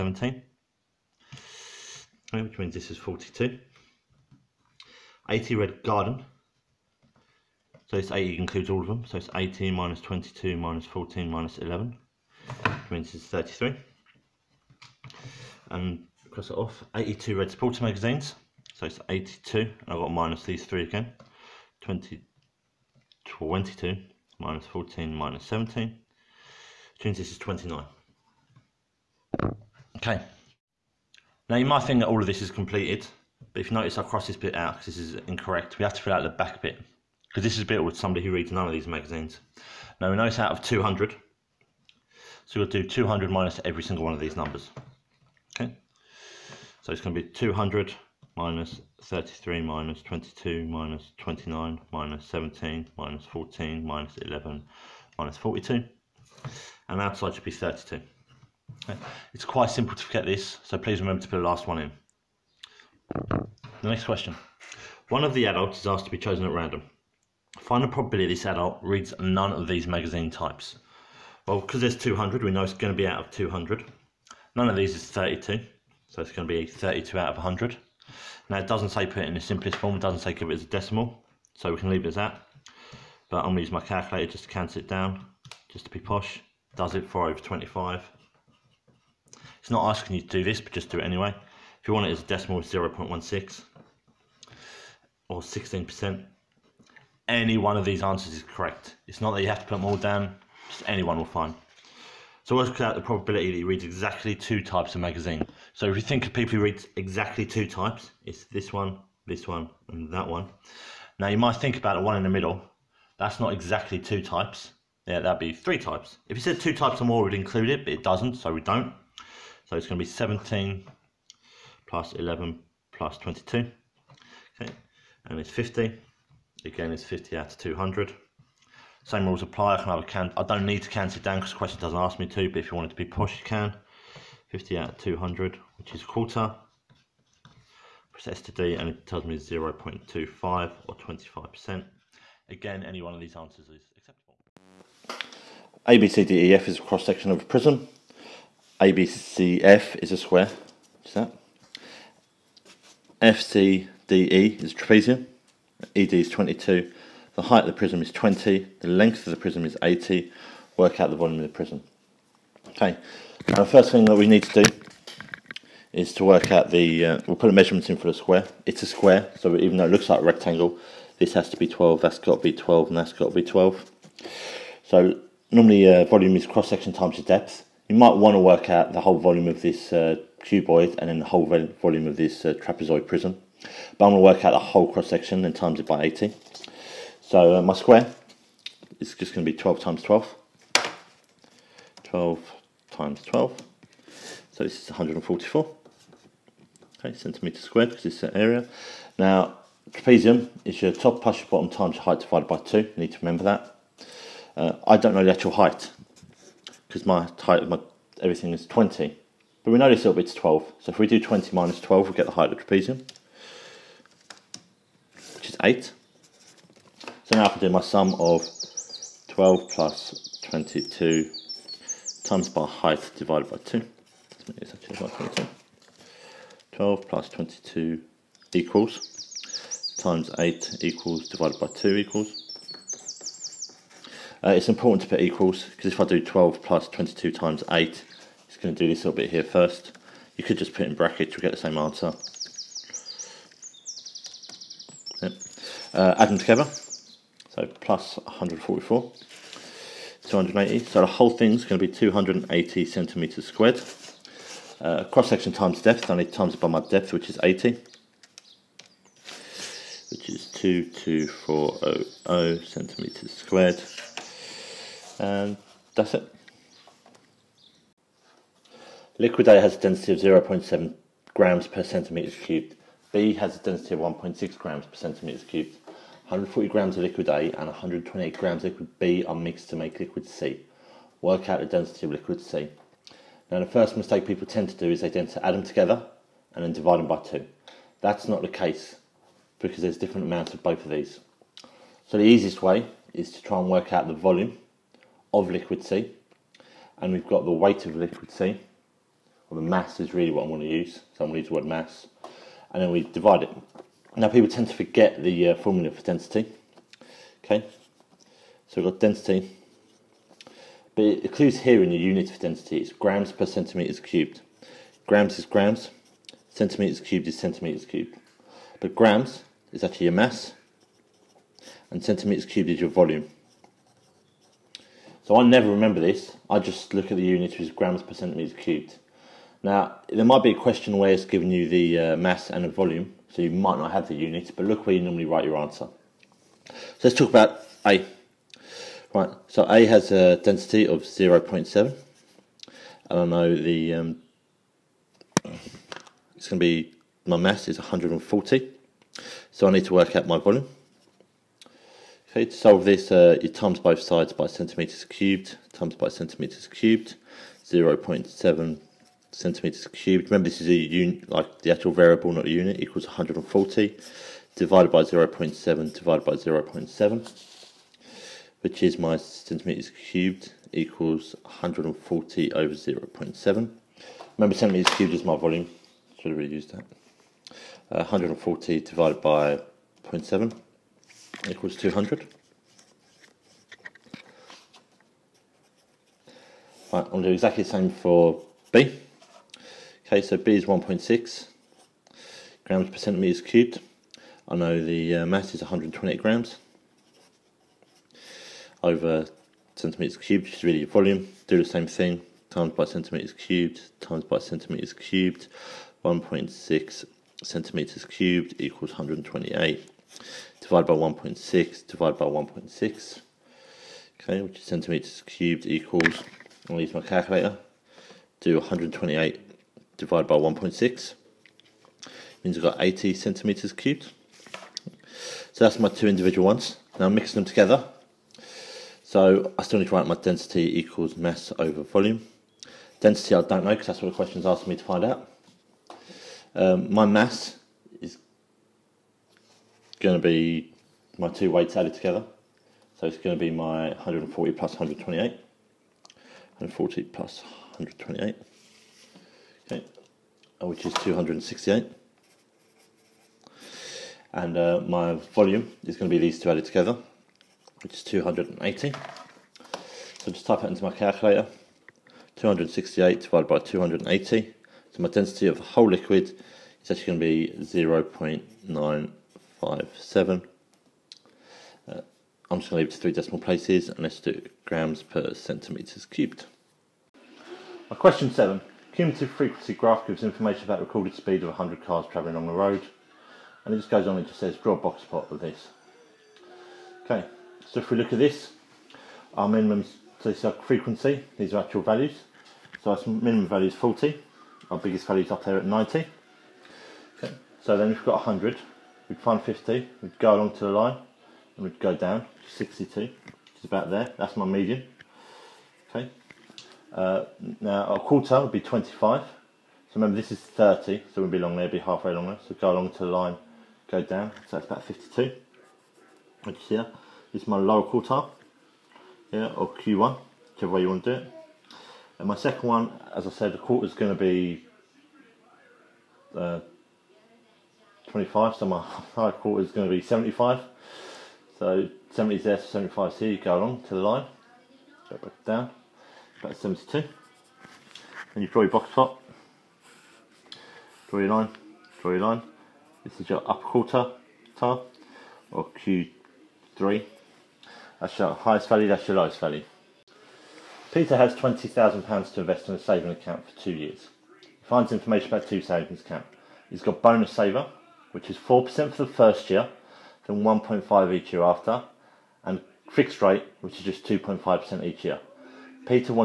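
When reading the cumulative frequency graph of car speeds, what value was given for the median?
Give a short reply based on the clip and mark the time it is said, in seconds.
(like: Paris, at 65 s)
62, at 501 s.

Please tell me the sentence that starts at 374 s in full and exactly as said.
Remember centimetres cubed is my volume, should have really used that.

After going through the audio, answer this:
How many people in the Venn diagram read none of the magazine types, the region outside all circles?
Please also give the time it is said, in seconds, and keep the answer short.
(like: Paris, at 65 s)
32, at 57 s.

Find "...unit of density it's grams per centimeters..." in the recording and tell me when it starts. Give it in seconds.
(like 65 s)
311 s.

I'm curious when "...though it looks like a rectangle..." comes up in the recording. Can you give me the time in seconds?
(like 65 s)
169 s.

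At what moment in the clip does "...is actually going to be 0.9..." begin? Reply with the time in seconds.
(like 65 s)
466 s.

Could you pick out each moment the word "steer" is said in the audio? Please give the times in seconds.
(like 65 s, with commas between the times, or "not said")
not said.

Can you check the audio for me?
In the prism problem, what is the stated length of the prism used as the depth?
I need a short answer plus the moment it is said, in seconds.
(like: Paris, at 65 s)
80, at 158 s.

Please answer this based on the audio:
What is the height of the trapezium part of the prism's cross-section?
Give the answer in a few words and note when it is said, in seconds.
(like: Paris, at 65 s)
8, at 215 s.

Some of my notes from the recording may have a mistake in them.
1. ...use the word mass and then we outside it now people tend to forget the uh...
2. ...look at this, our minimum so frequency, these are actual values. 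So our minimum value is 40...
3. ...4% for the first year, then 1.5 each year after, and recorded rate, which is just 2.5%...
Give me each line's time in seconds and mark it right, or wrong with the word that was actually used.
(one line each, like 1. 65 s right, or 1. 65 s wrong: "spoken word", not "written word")
1. 301 s wrong: "divide", not "outside"
2. 487 s right
3. 558 s wrong: "fixed", not "recorded".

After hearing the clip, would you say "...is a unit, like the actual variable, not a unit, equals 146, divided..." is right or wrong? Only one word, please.
wrong.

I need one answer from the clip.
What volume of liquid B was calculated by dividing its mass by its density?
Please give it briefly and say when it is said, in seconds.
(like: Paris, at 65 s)
80 centimetres cubed, at 422 s.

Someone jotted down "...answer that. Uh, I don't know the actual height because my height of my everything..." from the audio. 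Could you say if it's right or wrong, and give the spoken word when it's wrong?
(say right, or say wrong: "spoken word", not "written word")
wrong: "remember", not "answer".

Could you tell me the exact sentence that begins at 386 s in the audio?
Right, I'll do exactly the same for B.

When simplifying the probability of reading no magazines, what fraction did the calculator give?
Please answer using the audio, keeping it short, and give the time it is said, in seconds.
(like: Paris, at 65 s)
4/25, at 87 s.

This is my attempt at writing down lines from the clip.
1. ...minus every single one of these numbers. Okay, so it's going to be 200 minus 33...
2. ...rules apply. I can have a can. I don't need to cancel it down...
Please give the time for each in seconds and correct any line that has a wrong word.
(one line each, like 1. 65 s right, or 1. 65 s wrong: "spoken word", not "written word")
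1. 43 s right
2. 129 s right.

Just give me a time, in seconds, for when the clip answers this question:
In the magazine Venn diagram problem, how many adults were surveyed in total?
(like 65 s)
40 s.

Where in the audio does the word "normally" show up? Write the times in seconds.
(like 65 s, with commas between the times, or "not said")
175 s, 335 s.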